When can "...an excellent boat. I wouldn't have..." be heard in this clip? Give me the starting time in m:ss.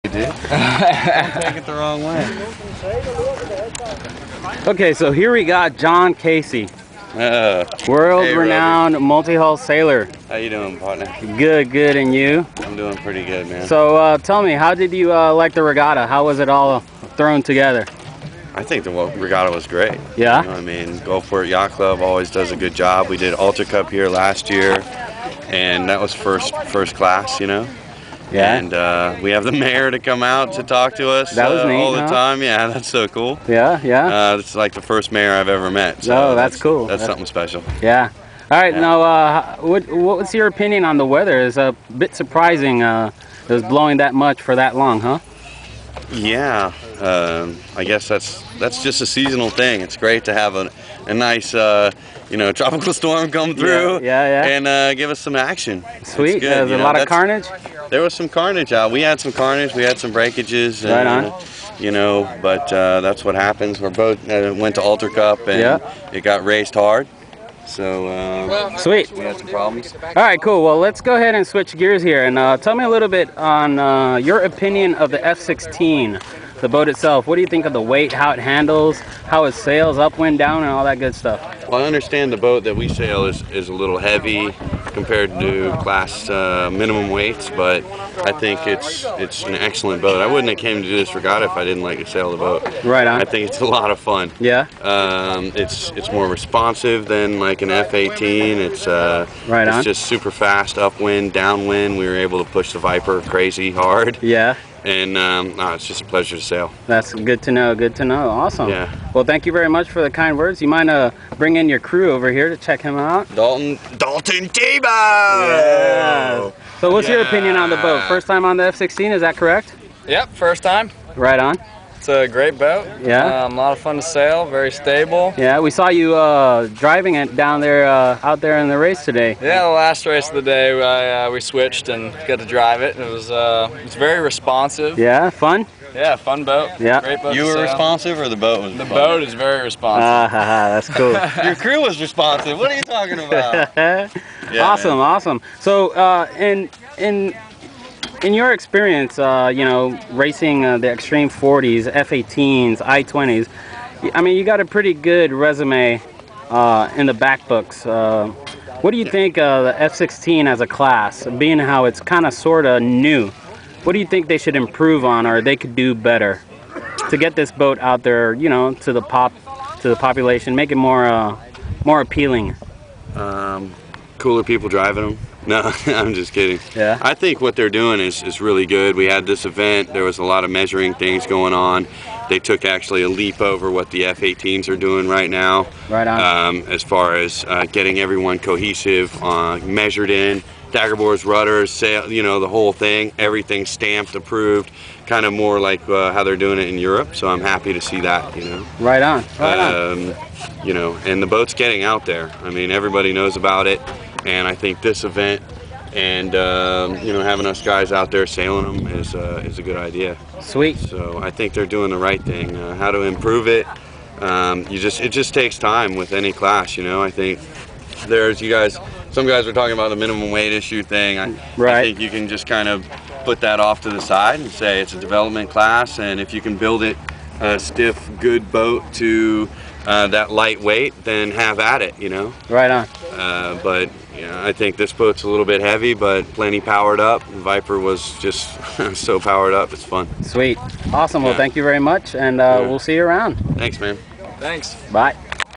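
1:29.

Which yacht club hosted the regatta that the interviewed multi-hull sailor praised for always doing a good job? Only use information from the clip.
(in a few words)
Gulfport Yacht Club.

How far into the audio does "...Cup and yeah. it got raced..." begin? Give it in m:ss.
1:05.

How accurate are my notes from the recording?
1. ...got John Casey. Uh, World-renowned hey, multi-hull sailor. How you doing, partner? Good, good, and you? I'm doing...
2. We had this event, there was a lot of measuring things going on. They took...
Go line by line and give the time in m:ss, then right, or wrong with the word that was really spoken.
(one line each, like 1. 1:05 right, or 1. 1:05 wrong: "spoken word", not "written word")
1. 0:05 right
2. 2:58 right.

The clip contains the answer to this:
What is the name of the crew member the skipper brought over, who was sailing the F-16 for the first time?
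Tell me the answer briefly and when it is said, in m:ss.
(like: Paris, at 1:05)
Dalton Tebow, at 1:53.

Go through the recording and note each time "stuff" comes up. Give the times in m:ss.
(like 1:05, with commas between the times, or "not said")
1:21.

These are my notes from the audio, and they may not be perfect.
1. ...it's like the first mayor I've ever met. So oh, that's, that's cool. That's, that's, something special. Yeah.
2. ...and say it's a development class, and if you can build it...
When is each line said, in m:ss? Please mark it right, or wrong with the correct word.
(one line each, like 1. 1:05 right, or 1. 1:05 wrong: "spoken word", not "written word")
1. 0:34 right
2. 3:44 right.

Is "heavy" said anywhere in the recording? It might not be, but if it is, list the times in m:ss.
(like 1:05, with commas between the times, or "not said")
1:23, 3:55.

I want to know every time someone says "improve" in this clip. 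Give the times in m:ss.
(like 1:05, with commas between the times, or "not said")
2:44, 3:33.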